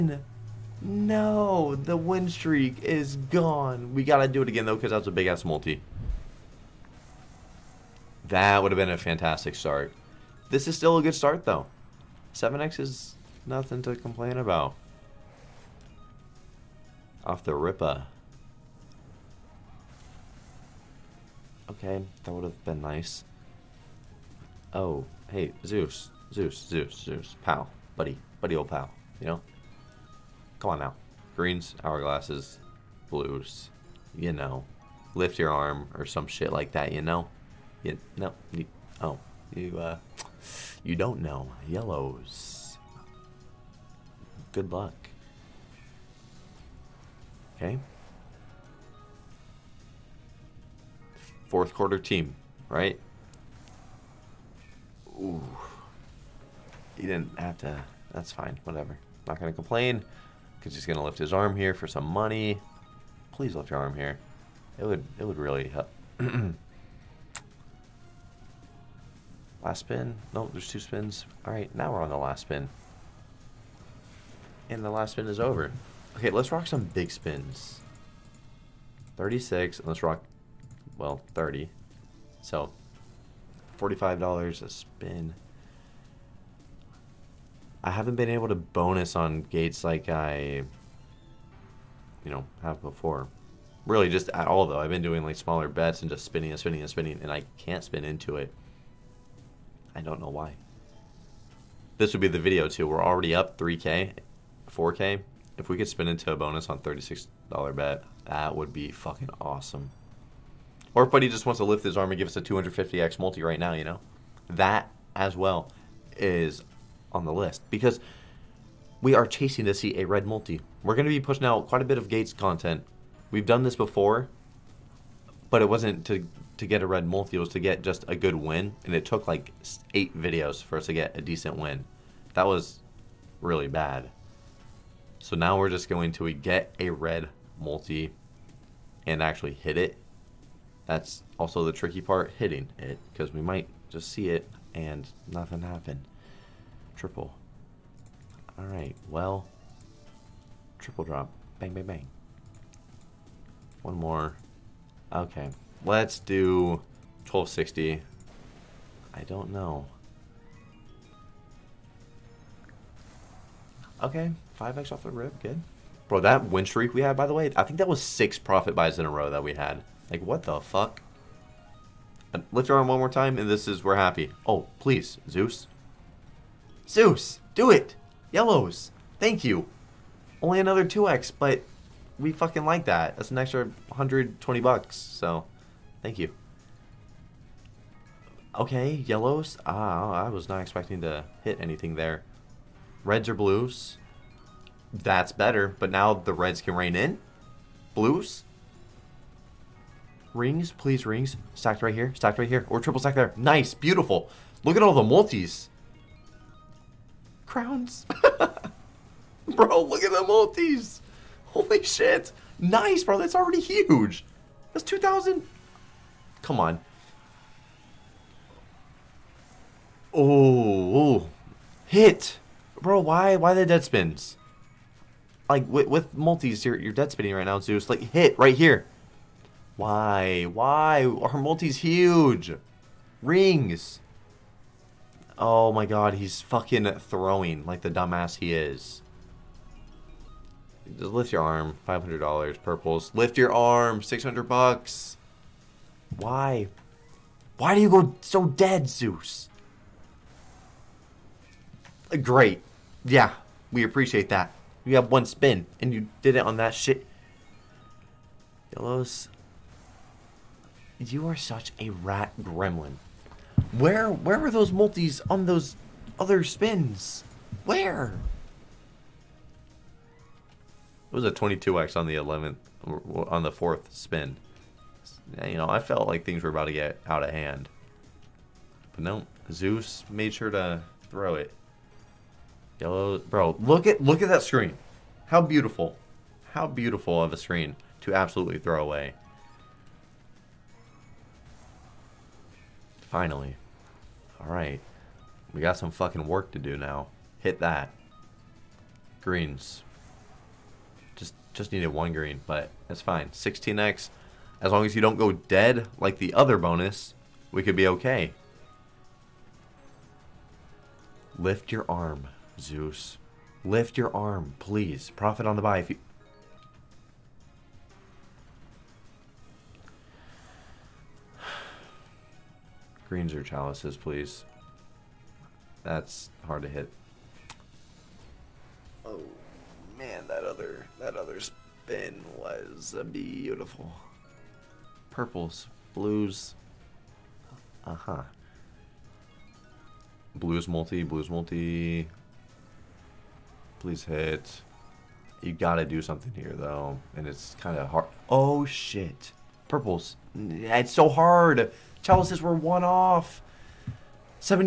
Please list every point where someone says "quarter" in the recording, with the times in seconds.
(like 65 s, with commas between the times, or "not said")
51 s.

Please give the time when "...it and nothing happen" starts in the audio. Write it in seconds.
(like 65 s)
144 s.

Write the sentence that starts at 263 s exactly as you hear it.
Where where were those multis on those other spins?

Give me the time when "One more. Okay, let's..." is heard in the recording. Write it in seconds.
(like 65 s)
153 s.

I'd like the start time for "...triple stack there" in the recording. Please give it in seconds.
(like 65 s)
202 s.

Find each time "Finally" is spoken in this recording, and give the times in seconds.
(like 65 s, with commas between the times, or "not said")
293 s.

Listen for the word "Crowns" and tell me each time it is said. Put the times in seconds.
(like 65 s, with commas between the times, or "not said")
207 s.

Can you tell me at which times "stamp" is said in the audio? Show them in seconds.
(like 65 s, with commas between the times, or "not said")
not said.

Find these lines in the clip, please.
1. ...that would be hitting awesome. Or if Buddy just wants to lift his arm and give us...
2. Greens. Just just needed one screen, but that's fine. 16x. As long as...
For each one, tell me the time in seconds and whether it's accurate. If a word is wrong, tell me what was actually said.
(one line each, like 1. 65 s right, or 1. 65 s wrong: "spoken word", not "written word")
1. 108 s wrong: "fucking", not "hitting"
2. 299 s wrong: "green", not "screen".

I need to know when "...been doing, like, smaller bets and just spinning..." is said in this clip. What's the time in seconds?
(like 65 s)
94 s.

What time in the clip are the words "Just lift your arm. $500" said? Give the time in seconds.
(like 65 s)
240 s.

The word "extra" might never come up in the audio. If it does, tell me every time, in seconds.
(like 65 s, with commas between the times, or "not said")
183 s.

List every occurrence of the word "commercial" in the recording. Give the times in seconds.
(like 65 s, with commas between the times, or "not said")
not said.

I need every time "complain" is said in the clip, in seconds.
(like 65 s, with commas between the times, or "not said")
13 s, 59 s.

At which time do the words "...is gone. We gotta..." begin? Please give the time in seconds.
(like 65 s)
2 s.